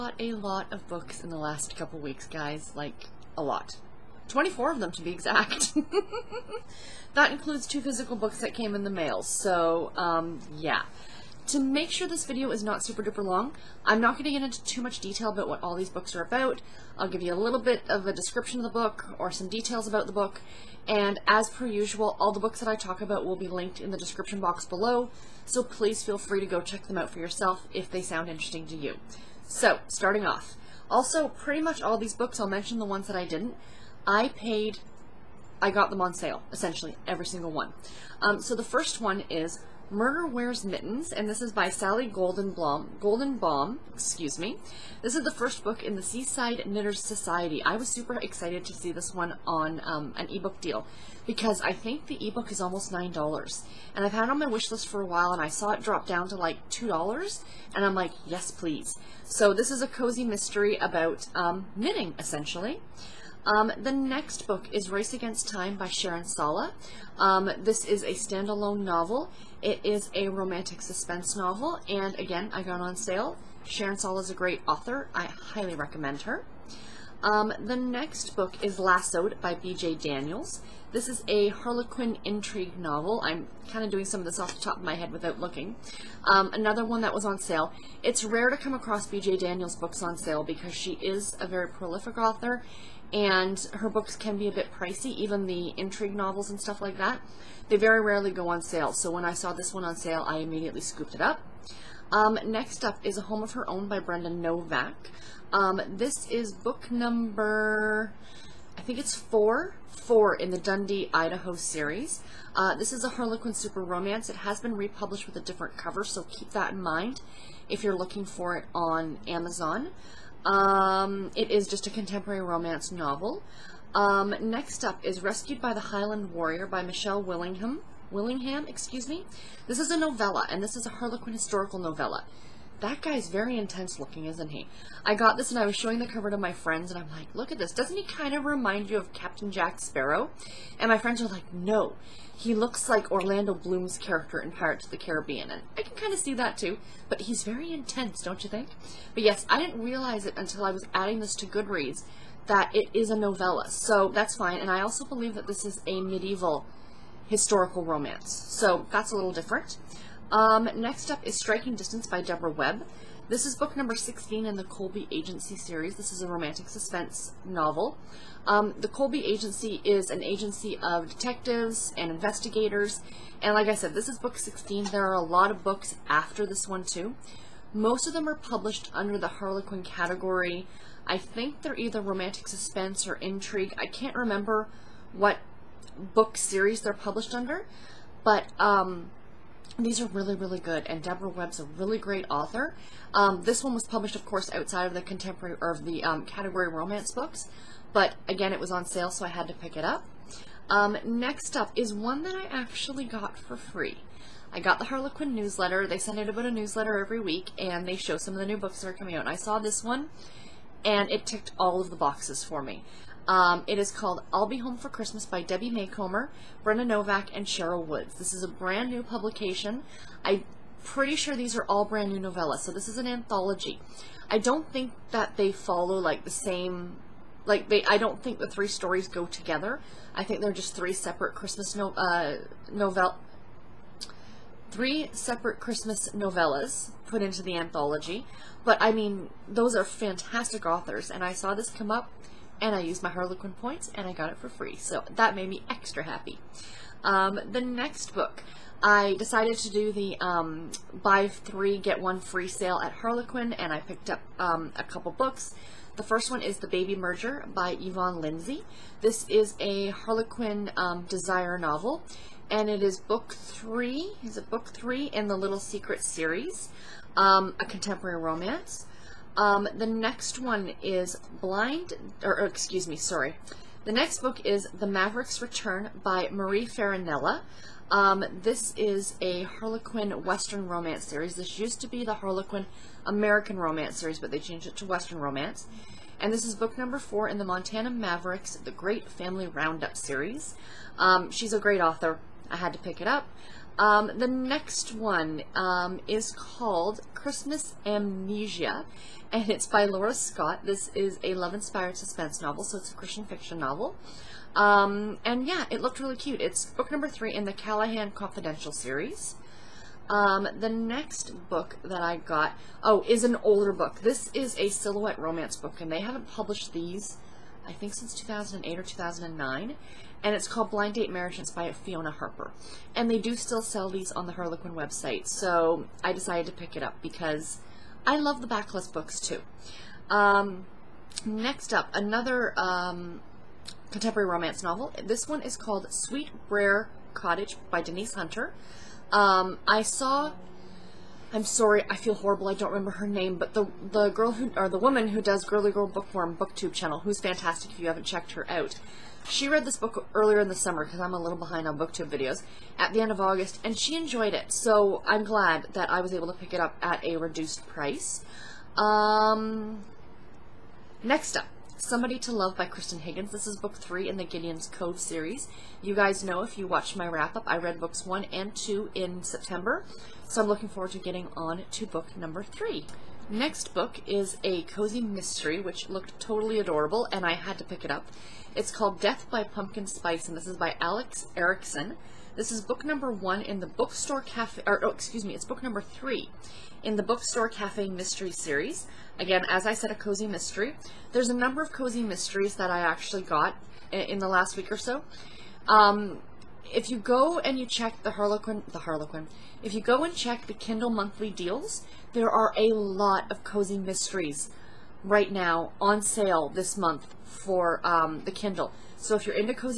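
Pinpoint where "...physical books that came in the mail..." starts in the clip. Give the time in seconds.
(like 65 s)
7 s.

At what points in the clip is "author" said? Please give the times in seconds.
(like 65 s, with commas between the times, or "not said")
74 s, 92 s, 192 s, 240 s, 291 s.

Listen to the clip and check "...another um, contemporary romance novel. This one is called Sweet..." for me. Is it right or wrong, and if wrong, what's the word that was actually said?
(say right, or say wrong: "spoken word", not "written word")
right.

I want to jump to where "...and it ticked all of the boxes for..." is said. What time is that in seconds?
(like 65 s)
210 s.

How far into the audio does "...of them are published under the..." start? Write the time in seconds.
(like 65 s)
178 s.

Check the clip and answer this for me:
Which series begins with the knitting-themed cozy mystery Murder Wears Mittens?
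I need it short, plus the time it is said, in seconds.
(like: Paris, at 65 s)
Seaside Knitters Society, at 46 s.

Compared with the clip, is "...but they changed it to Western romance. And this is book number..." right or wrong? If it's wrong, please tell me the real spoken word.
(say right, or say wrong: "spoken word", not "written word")
right.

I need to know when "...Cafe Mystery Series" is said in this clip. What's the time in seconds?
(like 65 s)
387 s.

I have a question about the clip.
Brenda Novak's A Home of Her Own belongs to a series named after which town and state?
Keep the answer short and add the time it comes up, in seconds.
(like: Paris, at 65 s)
Dundee, Idaho, at 110 s.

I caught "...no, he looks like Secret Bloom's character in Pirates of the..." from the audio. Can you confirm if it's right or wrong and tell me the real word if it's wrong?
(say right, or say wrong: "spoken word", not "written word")
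wrong: "Orlando", not "Secret".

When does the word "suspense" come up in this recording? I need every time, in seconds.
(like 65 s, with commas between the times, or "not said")
70 s, 166 s, 182 s, 301 s.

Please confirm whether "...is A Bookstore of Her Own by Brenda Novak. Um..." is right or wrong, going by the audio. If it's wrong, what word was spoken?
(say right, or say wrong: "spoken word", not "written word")
wrong: "Home", not "Bookstore".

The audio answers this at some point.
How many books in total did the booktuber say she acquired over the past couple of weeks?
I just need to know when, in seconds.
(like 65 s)
4 s.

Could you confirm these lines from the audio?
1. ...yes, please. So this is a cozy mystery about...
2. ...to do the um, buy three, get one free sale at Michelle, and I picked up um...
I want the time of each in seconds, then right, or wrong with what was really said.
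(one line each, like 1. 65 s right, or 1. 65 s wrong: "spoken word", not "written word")
1. 58 s right
2. 249 s wrong: "Harlequin", not "Michelle".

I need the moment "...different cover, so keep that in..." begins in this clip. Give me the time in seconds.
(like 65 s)
115 s.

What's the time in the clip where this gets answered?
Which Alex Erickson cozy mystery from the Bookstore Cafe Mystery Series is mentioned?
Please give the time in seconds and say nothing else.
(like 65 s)
378 s.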